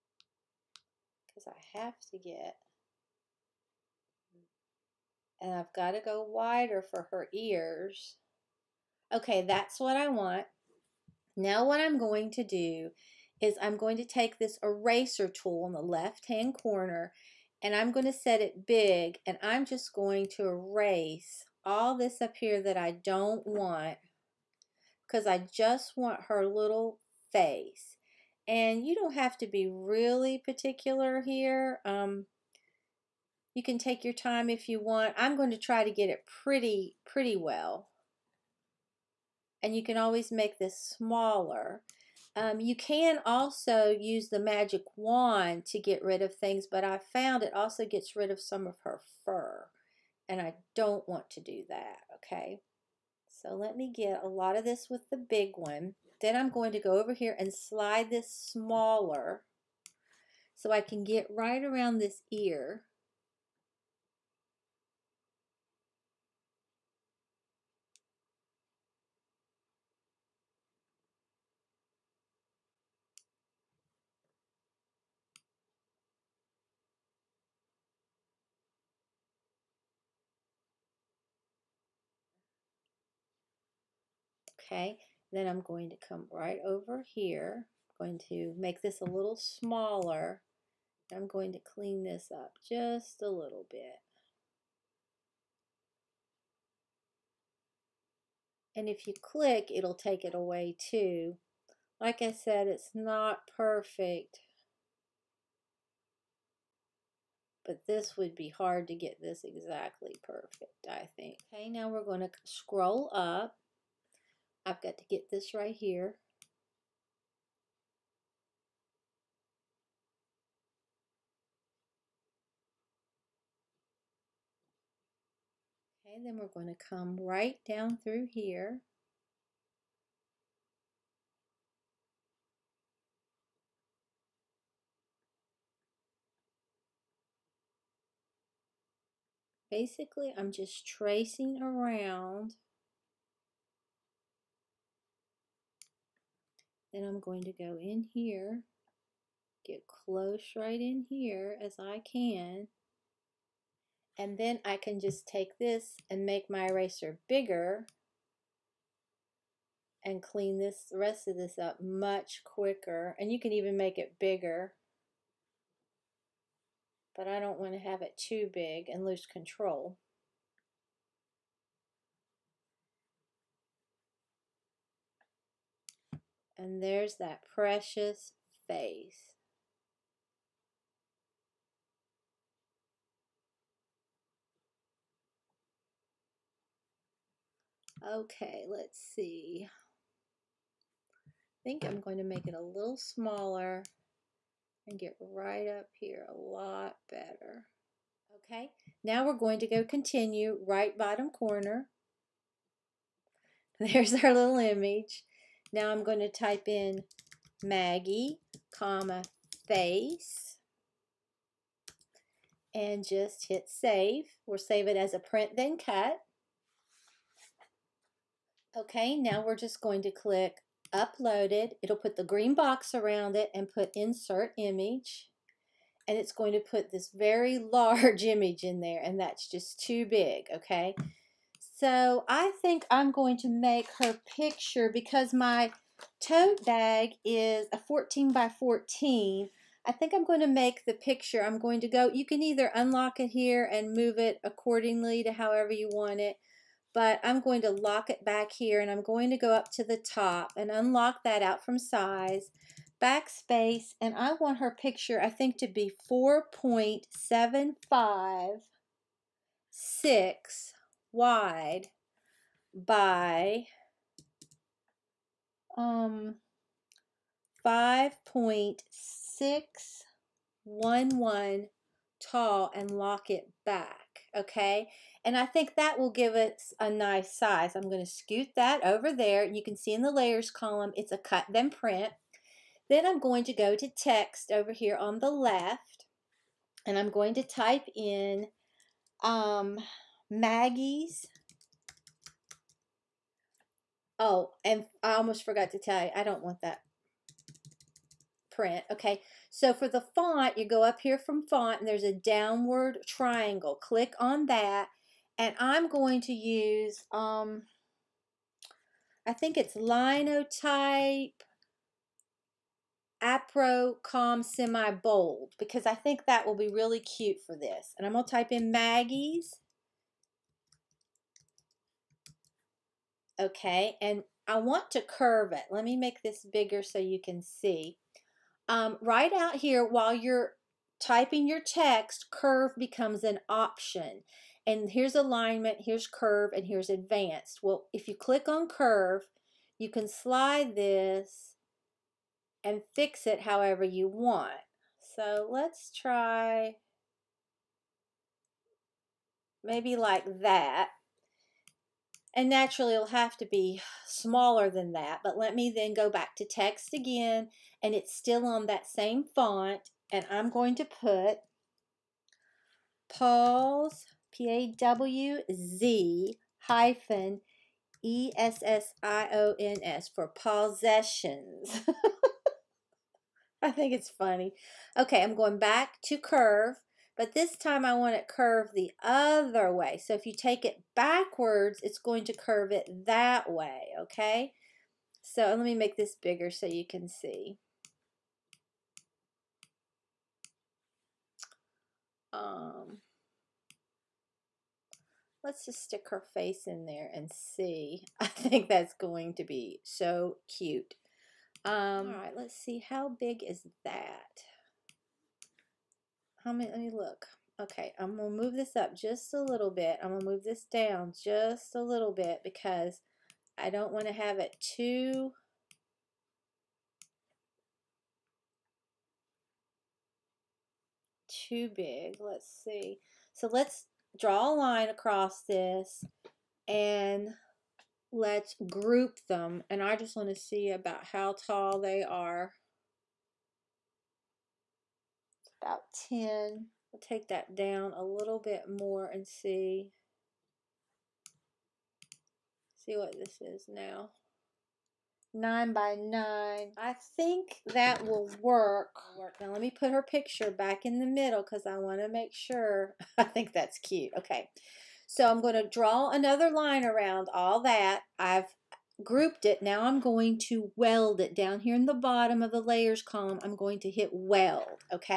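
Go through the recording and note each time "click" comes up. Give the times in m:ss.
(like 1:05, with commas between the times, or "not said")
1:39, 3:40, 5:03, 5:38.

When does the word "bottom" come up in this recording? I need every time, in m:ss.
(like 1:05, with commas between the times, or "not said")
3:20, 7:41.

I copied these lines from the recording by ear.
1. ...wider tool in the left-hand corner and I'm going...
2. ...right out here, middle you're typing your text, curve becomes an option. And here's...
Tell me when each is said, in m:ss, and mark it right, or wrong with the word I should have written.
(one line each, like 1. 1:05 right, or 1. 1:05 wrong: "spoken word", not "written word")
1. 0:14 wrong: "eraser", not "wider"
2. 5:29 wrong: "while", not "middle".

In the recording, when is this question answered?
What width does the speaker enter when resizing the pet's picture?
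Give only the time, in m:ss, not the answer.
4:16.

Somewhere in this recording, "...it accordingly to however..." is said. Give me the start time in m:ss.
4:04.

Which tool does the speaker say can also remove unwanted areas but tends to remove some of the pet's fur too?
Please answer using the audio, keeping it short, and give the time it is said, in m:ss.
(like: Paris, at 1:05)
magic wand, at 0:44.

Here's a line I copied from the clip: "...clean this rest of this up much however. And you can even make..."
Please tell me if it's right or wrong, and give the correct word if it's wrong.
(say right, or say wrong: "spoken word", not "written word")
wrong: "quicker", not "however".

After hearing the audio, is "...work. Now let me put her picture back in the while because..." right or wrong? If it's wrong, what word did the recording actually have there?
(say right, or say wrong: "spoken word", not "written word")
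wrong: "middle", not "while".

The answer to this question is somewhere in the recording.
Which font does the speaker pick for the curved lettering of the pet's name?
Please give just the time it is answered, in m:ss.
5:09.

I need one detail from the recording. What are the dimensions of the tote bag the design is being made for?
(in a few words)
14 by 14.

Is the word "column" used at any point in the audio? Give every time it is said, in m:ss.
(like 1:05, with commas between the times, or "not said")
4:40, 7:43.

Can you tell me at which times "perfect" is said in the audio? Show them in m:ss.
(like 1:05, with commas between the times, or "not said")
1:43, 1:50.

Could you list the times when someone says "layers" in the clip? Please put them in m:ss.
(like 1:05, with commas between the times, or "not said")
4:40, 7:42.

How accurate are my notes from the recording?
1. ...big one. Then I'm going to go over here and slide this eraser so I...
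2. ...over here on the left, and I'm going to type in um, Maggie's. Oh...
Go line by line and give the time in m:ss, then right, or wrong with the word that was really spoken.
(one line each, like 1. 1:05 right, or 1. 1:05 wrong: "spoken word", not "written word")
1. 0:55 wrong: "smaller", not "eraser"
2. 4:44 right.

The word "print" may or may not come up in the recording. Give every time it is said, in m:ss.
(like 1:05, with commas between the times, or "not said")
3:35, 4:41, 4:58.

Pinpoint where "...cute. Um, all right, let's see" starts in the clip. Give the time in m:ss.
6:40.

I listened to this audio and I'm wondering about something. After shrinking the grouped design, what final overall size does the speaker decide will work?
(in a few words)
9 by 9.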